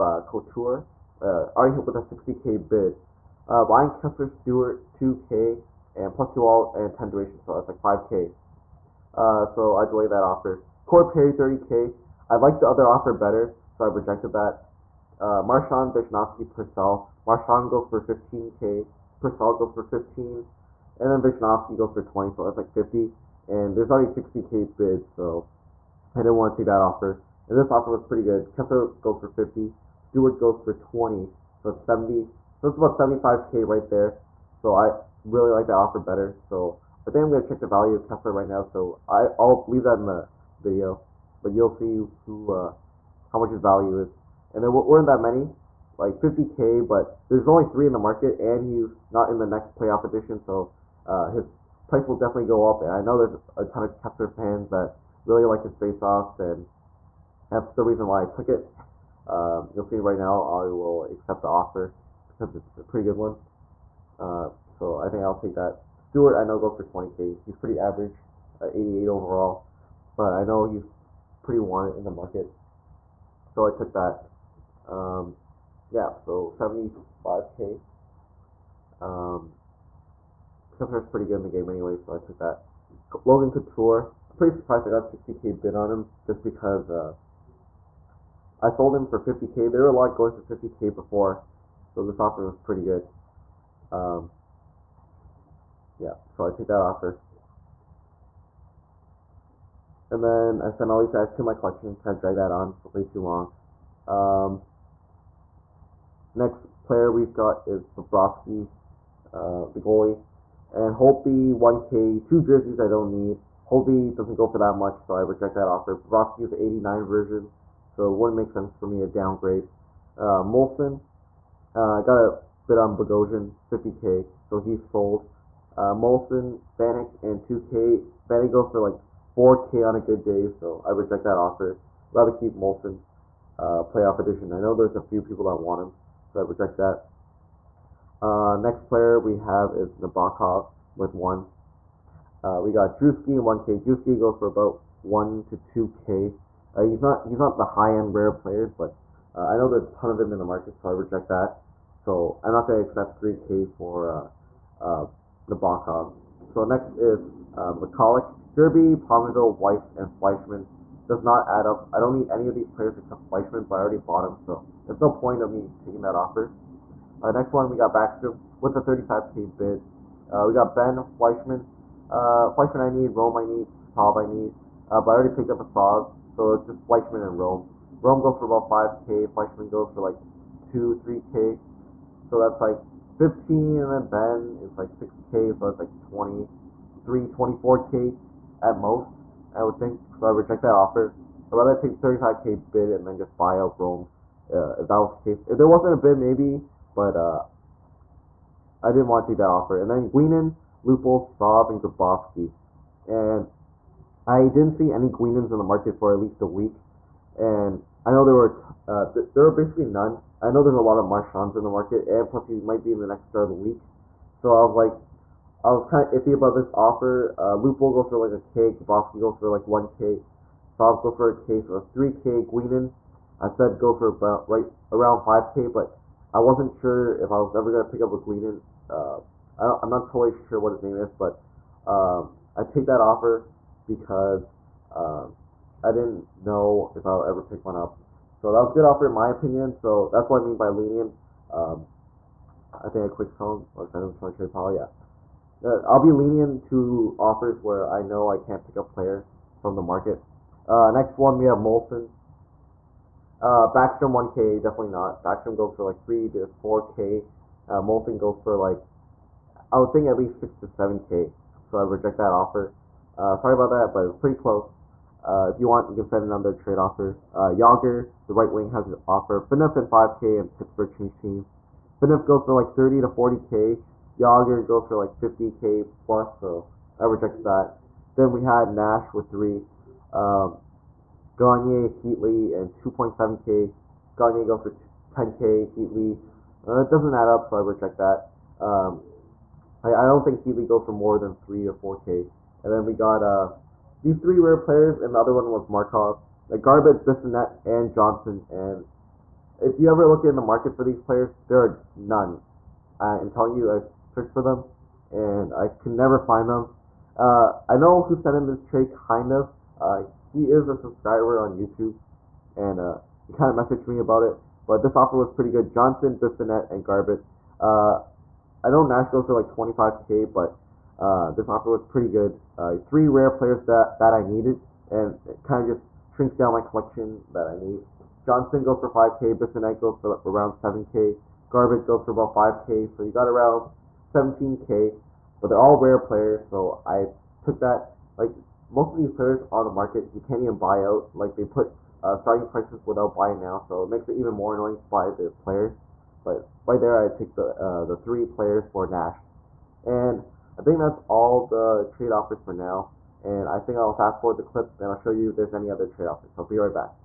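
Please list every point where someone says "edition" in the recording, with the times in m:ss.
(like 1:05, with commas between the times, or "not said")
0:50, 2:14.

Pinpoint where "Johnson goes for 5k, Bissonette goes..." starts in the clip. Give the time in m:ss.
5:28.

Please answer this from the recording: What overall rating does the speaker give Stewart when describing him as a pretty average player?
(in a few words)
88.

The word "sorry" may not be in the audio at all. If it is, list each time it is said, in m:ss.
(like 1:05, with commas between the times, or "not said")
4:23.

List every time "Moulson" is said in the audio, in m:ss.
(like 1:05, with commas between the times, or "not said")
2:00, 2:05, 2:12, 4:11, 4:17.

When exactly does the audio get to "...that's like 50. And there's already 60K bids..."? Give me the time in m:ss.
0:22.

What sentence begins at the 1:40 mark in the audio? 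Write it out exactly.
And then I send all these guys to my collection Kind of drag that on for way too long.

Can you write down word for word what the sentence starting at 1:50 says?
And Holtby 1K, two jerseys I don't need.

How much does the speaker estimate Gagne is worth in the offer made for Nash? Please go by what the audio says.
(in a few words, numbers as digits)
10K.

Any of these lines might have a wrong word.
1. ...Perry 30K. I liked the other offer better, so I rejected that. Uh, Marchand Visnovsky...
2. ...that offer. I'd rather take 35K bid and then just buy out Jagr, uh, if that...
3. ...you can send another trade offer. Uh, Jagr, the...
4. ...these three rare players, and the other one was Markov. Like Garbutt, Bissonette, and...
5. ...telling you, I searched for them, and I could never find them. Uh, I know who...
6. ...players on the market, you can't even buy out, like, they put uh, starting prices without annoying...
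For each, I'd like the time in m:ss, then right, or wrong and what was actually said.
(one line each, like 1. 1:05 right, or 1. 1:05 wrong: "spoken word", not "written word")
1. 0:11 right
2. 3:10 wrong: "Rome", not "Jagr"
3. 4:25 right
4. 4:54 right
5. 5:03 right
6. 5:39 wrong: "buying", not "annoying".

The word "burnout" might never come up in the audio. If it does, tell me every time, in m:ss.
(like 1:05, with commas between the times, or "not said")
not said.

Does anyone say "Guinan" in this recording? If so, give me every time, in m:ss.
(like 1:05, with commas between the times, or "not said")
3:20, 3:25, 3:42, 3:48.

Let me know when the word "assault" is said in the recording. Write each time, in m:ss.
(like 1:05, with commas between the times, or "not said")
not said.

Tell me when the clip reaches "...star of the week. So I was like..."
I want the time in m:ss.
3:33.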